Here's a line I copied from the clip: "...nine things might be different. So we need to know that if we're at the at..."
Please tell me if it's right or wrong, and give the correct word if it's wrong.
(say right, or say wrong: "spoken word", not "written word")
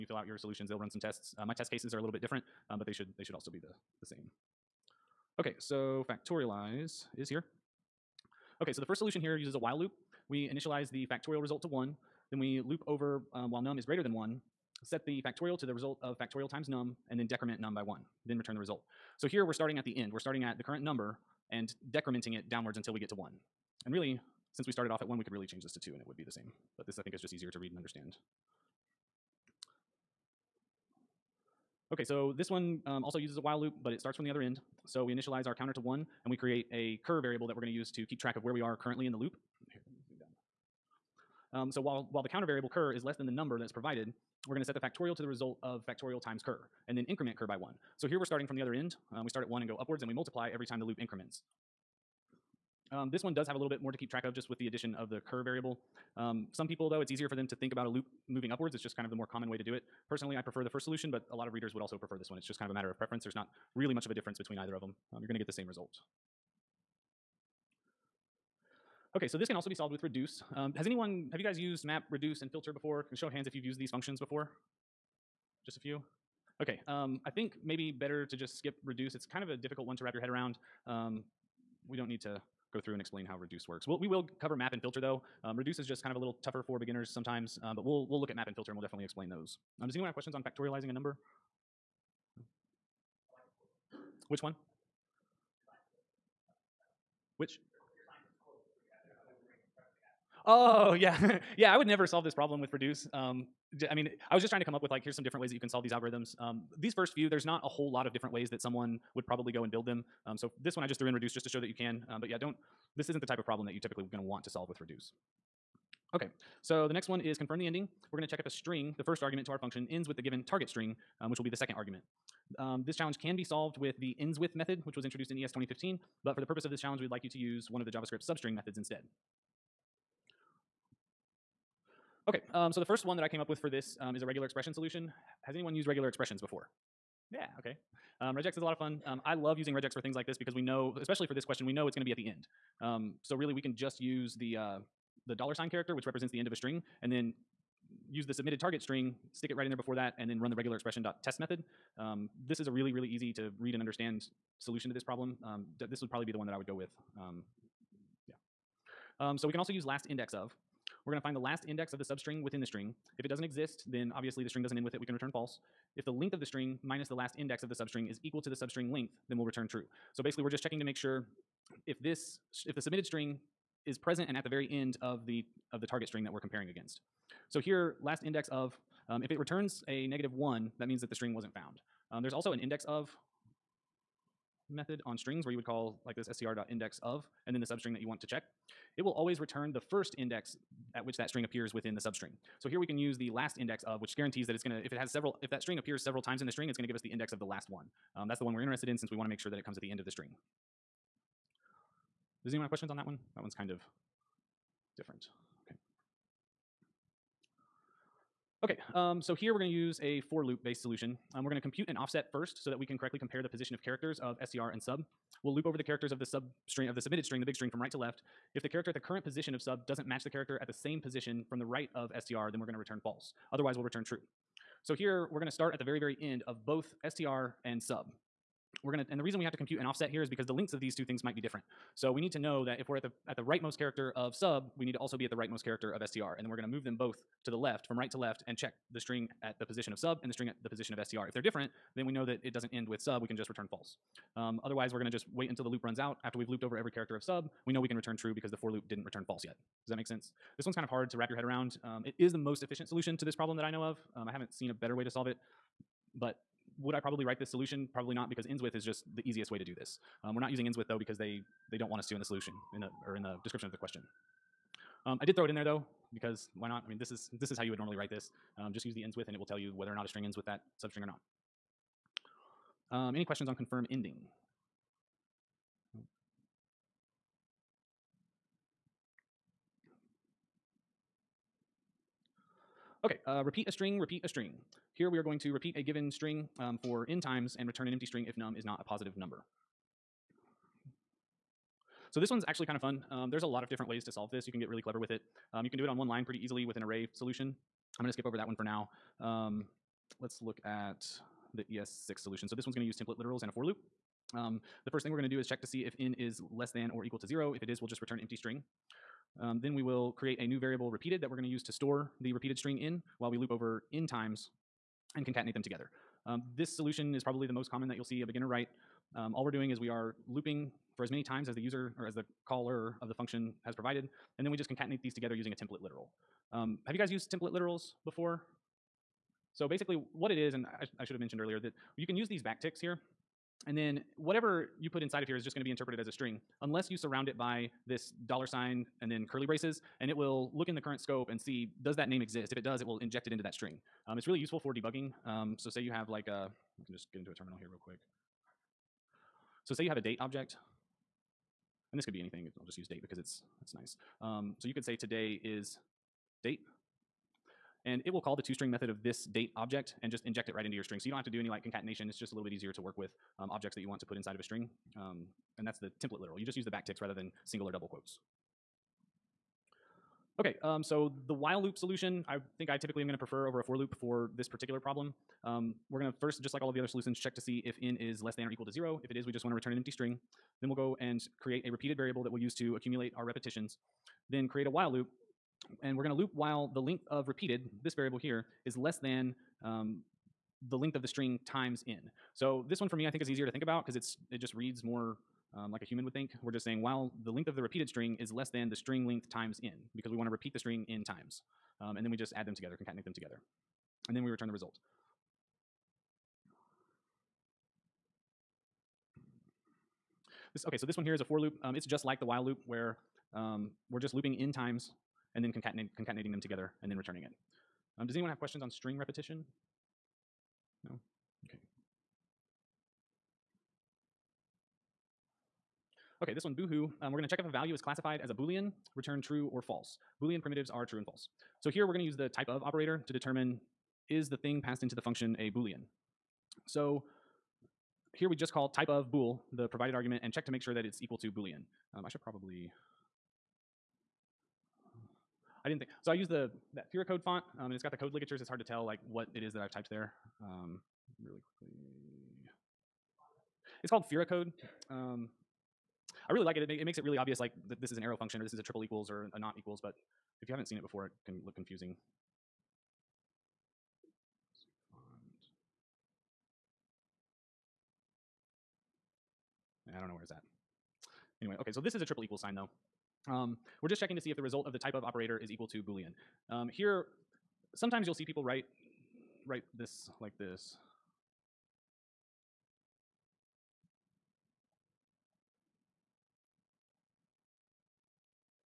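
wrong: "two", not "nine".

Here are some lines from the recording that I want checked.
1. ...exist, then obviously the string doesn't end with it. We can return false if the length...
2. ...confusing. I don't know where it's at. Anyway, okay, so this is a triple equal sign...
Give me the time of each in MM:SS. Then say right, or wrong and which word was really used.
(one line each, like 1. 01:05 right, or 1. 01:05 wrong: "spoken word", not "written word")
1. 02:43 right
2. 07:41 right.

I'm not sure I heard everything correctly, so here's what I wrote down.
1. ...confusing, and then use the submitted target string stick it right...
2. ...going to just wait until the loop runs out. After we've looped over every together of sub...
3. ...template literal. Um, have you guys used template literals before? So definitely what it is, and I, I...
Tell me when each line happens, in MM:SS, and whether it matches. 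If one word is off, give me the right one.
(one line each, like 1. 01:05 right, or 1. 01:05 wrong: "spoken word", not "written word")
1. 02:26 wrong: "string", not "confusing"
2. 04:04 wrong: "character", not "together"
3. 05:25 wrong: "basically", not "definitely".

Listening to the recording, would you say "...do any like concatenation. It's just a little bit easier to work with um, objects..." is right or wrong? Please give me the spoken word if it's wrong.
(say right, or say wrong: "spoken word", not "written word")
right.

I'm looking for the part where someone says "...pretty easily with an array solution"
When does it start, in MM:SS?
04:56.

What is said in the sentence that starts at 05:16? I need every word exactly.
Um, this solution is probably the most common that you'll see a beginner write.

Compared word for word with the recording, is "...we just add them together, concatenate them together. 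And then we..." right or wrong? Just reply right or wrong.
right.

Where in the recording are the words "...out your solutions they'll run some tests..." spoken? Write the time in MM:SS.
00:00.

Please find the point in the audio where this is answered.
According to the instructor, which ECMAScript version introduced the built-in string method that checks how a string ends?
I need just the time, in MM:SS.
02:05.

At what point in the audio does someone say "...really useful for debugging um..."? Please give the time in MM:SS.
05:44.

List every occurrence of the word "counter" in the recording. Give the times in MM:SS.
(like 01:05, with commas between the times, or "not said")
00:35, 00:42.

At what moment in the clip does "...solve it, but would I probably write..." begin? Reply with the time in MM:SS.
04:15.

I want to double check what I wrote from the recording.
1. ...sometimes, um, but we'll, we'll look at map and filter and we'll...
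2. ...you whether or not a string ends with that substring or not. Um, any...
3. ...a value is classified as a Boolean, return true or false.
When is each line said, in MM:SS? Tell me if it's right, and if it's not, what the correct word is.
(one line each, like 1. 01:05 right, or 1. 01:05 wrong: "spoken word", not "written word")
1. 01:27 right
2. 04:29 right
3. 07:07 right.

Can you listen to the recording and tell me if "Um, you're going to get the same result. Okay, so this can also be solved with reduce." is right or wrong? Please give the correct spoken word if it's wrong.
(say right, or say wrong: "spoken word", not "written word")
right.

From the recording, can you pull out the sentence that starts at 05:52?
I'll just use date because it's it's nice.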